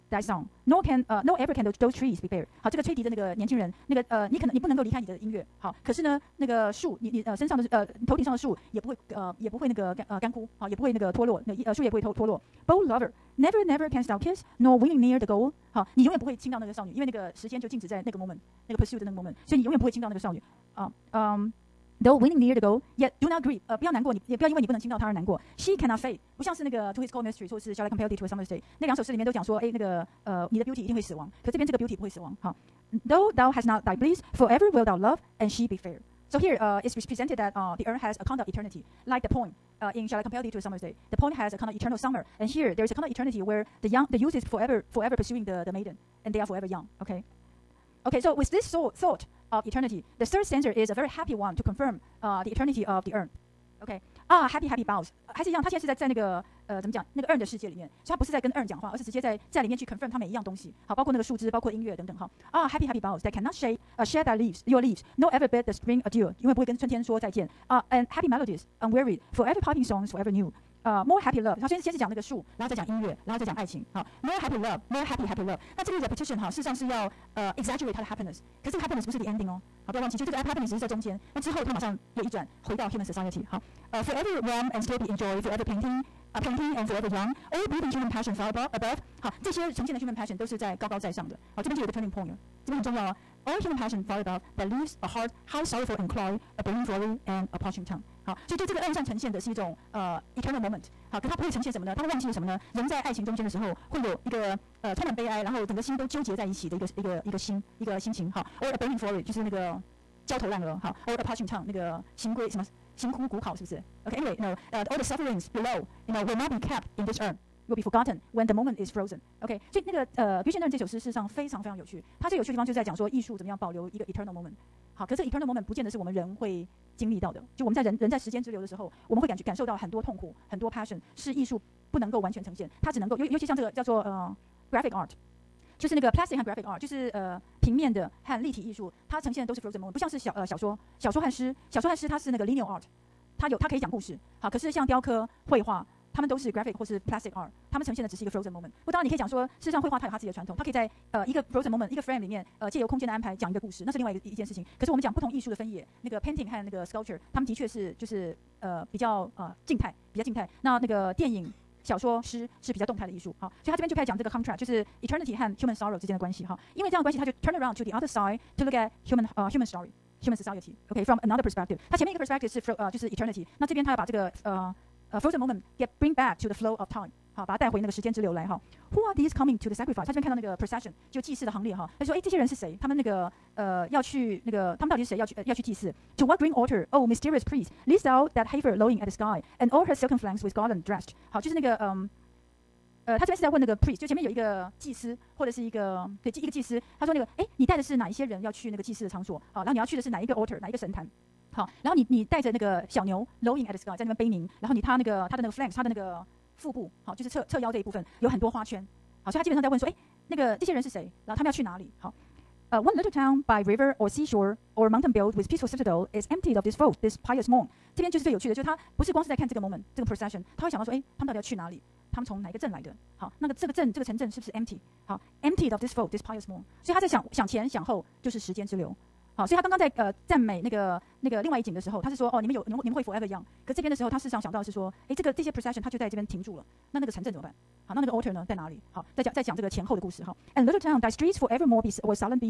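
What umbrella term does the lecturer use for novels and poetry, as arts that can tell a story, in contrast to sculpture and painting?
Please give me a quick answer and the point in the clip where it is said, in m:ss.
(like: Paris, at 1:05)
linear art, at 2:22.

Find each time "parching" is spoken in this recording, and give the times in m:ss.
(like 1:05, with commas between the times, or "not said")
1:37, 1:51.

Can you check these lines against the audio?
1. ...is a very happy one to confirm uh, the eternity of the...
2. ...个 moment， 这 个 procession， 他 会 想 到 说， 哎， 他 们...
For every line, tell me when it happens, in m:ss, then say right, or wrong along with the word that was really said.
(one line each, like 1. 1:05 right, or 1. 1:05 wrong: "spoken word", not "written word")
1. 0:50 right
2. 3:39 right.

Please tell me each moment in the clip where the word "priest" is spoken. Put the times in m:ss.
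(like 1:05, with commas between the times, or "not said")
3:07, 3:13.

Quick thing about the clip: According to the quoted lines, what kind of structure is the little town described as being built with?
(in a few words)
peaceful citadel.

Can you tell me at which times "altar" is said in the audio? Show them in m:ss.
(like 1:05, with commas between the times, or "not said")
3:06, 3:20, 3:58.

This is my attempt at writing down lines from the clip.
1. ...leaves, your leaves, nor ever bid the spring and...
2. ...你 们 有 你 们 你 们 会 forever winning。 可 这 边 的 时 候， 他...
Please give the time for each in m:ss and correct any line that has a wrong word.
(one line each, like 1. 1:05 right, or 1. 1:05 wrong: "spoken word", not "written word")
1. 1:04 right
2. 3:52 wrong: "young", not "winning".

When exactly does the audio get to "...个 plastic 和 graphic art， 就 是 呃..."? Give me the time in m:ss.
2:15.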